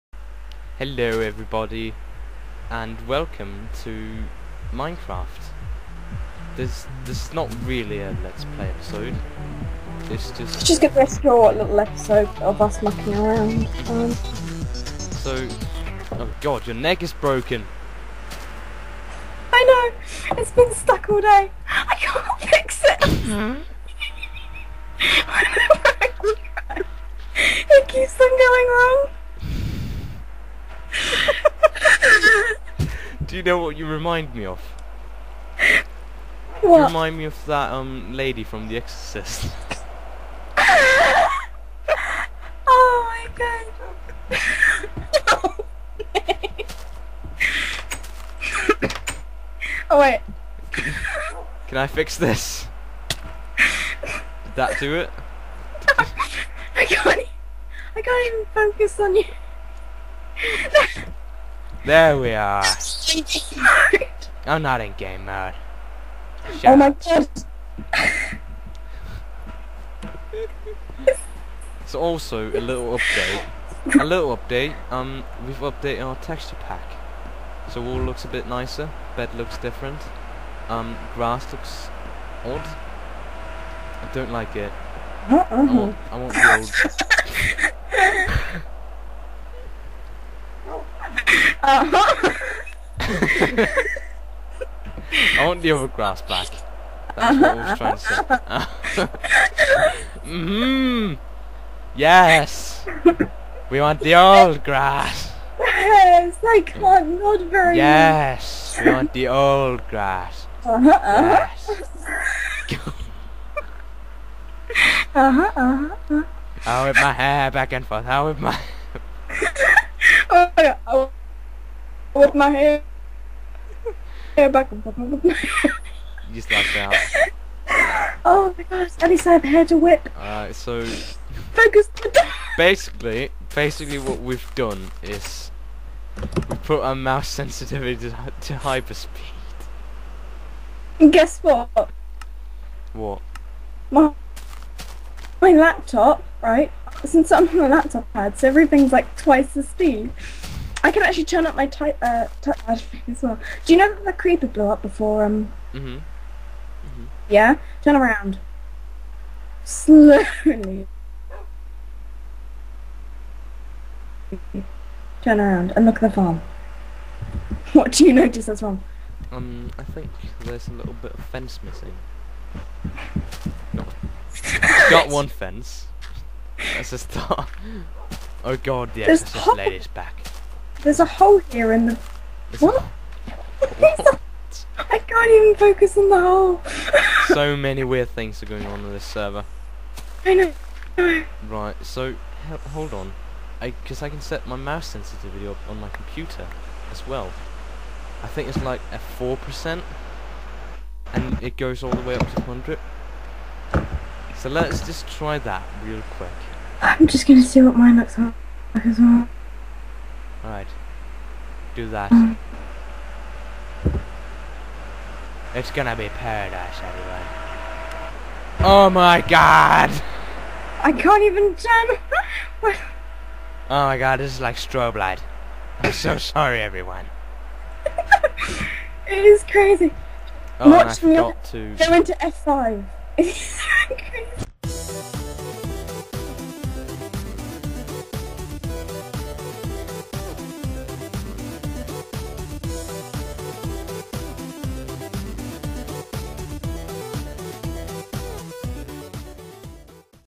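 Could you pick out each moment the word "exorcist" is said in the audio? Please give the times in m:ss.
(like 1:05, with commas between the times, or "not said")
0:38, 2:59.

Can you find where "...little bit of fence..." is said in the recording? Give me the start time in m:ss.
2:50.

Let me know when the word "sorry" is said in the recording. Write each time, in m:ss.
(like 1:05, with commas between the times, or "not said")
3:46.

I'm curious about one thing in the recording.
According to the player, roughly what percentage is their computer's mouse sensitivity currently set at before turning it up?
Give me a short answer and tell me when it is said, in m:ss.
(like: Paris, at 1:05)
4 percent, at 3:18.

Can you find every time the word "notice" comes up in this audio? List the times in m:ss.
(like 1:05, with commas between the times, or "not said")
2:48.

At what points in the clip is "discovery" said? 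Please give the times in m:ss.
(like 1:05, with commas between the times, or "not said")
not said.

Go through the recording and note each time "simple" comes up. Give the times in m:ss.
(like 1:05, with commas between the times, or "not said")
not said.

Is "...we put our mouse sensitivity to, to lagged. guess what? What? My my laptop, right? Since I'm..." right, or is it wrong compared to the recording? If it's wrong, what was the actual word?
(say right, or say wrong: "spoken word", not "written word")
wrong: "hyperspeed", not "lagged".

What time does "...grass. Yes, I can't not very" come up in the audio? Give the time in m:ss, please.
1:44.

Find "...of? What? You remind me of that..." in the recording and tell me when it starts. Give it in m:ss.
0:34.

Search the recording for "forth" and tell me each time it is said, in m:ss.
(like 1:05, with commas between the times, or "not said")
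1:57, 2:04.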